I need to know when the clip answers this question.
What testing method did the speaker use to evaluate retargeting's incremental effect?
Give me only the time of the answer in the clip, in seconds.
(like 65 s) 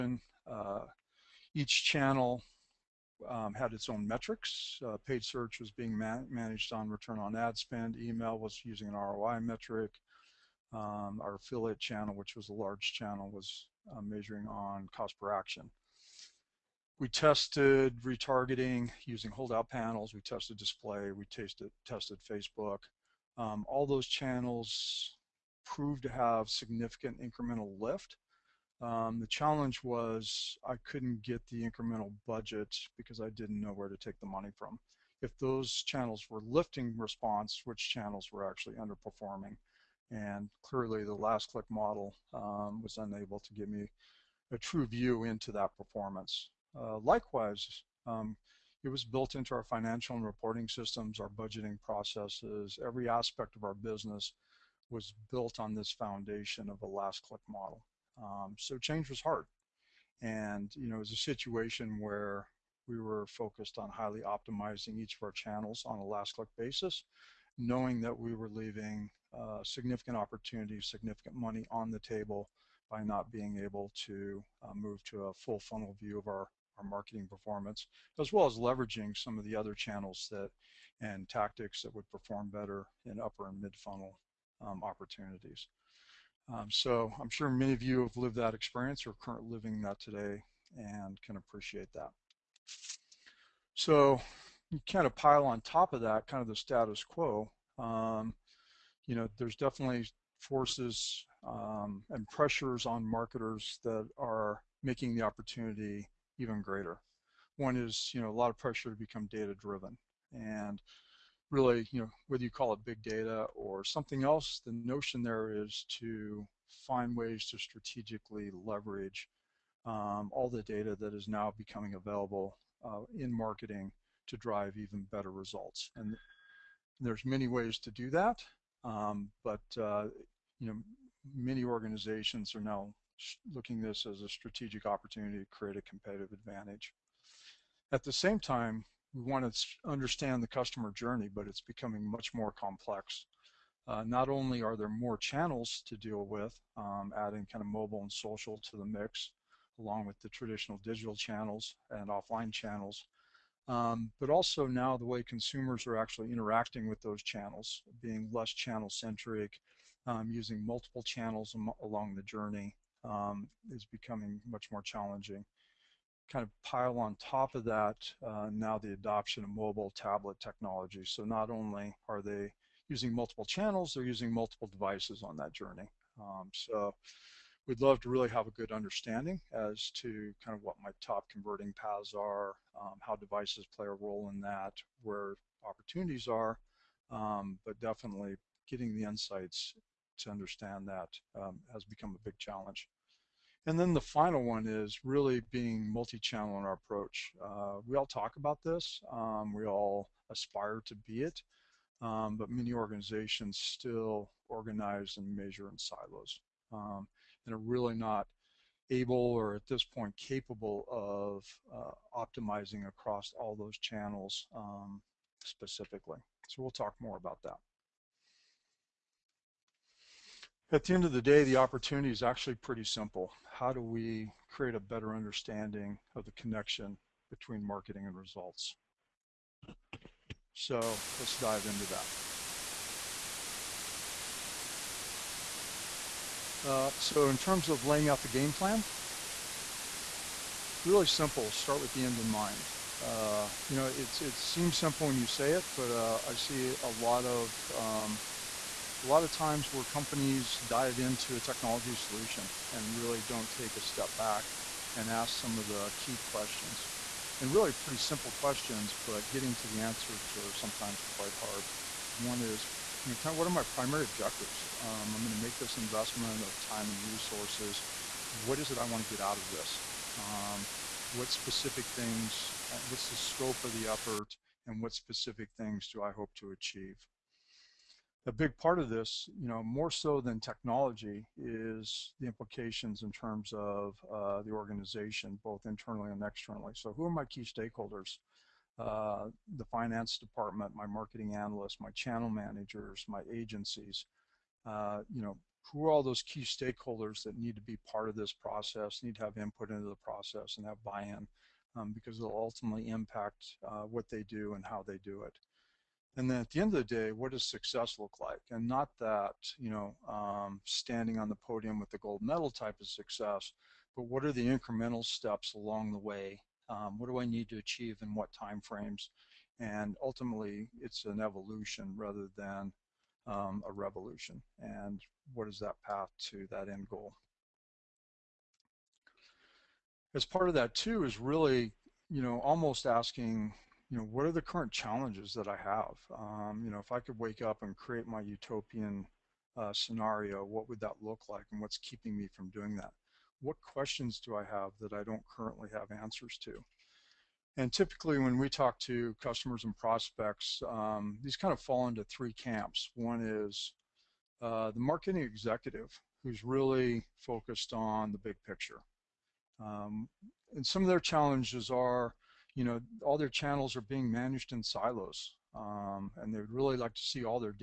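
19 s.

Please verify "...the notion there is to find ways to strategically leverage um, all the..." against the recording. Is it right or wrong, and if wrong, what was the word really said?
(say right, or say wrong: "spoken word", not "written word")
right.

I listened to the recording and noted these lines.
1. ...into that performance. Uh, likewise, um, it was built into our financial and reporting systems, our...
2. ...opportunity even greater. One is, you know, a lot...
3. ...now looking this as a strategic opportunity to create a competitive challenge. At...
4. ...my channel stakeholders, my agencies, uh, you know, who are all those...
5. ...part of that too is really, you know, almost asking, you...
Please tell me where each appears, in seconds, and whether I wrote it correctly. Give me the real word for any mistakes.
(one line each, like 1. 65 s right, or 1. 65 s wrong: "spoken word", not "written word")
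1. 45 s right
2. 105 s right
3. 132 s wrong: "advantage", not "challenge"
4. 291 s wrong: "managers", not "stakeholders"
5. 330 s right.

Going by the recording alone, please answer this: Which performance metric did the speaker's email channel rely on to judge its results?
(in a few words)
ROI.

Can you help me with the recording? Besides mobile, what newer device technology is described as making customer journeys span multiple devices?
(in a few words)
Tablet.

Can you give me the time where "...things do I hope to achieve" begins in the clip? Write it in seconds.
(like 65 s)
275 s.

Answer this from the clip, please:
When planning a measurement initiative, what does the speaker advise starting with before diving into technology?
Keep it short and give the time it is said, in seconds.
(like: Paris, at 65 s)
The end in mind, at 241 s.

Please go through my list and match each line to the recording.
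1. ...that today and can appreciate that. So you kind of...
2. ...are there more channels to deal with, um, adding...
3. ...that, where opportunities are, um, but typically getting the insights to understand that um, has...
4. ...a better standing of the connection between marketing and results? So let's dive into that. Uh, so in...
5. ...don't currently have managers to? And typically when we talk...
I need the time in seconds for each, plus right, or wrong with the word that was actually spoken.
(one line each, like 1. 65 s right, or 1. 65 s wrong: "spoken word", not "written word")
1. 89 s right
2. 144 s right
3. 184 s wrong: "definitely", not "typically"
4. 224 s wrong: "understanding", not "standing"
5. 345 s wrong: "answers", not "managers".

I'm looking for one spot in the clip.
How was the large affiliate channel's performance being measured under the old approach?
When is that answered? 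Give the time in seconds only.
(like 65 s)
14 s.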